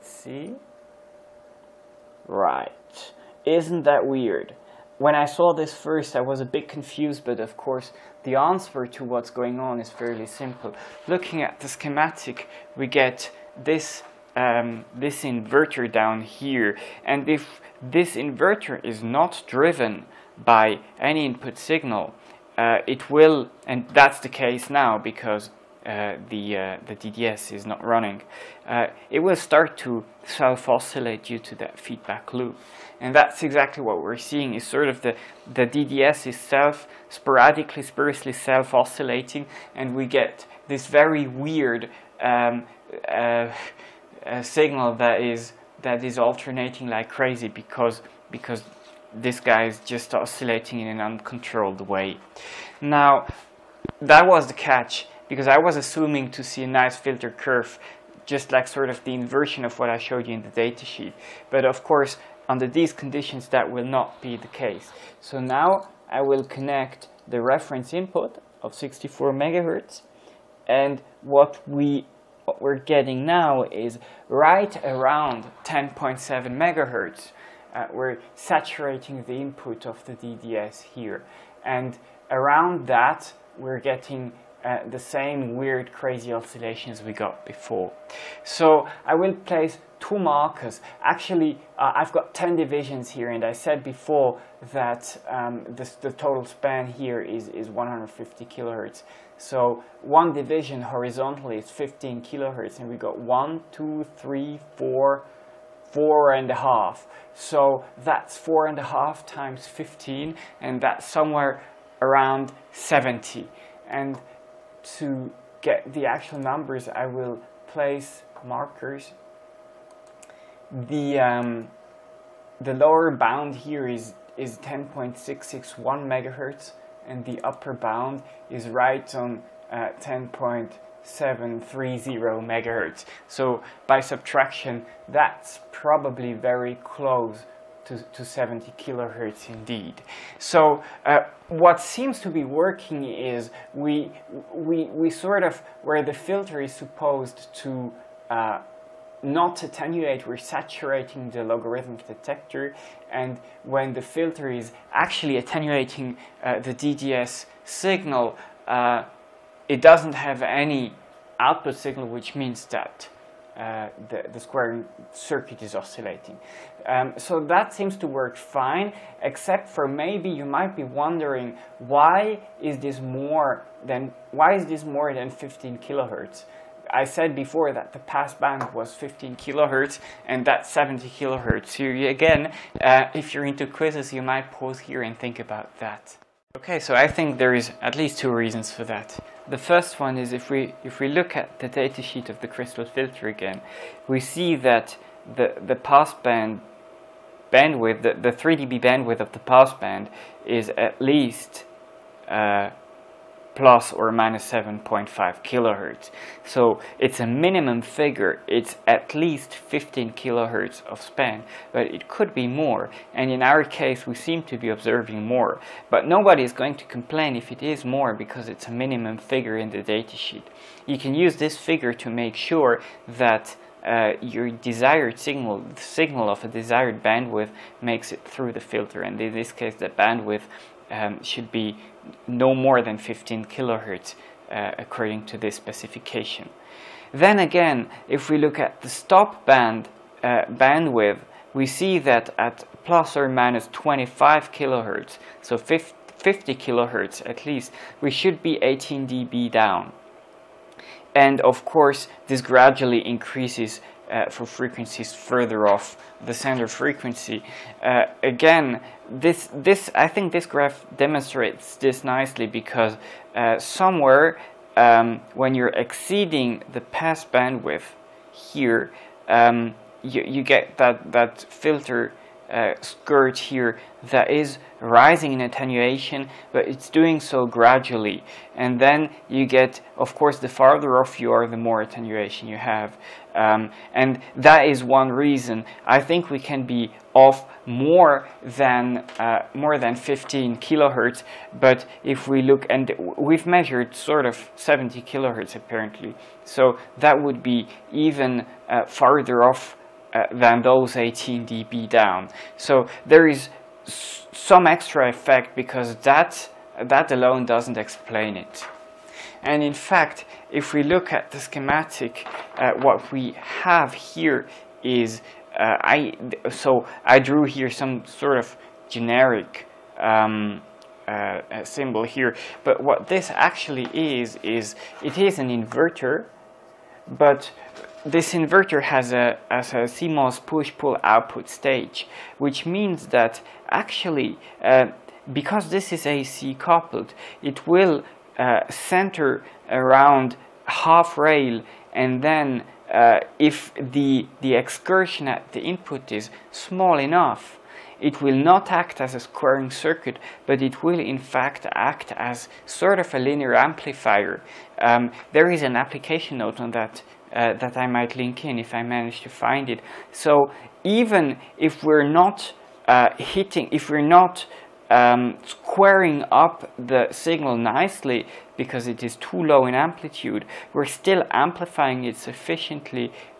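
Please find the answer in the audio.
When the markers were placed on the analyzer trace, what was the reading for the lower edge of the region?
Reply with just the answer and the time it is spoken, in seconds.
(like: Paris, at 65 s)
10.661 MHz, at 124 s.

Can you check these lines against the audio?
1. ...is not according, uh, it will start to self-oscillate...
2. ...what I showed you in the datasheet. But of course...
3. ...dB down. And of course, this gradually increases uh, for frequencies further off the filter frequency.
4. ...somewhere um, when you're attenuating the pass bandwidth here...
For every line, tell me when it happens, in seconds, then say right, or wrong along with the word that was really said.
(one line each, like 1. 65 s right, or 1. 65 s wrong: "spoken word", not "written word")
1. 27 s wrong: "running", not "according"
2. 59 s right
3. 249 s wrong: "center", not "filter"
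4. 263 s wrong: "exceeding", not "attenuating".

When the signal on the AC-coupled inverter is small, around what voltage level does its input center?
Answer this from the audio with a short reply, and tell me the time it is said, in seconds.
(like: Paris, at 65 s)
half rail, at 340 s.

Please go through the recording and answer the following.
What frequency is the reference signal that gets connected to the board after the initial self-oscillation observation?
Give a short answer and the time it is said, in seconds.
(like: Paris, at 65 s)
64 MHz, at 68 s.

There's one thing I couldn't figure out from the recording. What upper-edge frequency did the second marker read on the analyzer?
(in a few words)
10.730 MHz.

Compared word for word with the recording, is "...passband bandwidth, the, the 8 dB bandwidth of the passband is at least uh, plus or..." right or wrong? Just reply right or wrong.
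wrong.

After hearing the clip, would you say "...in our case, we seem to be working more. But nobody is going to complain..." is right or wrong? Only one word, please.
wrong.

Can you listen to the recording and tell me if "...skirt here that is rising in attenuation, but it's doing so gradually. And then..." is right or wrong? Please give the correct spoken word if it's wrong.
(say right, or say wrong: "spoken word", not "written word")
right.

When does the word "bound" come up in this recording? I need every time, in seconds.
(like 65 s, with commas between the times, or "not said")
123 s, 127 s.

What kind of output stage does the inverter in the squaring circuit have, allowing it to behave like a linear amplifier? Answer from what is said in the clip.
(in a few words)
CMOS push-pull.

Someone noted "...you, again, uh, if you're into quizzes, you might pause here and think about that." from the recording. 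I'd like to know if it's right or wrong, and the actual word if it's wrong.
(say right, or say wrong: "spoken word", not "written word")
right.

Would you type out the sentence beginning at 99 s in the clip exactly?
So one division horizontally is 15 kilohertz, and we got one, two, three, four, four and a half.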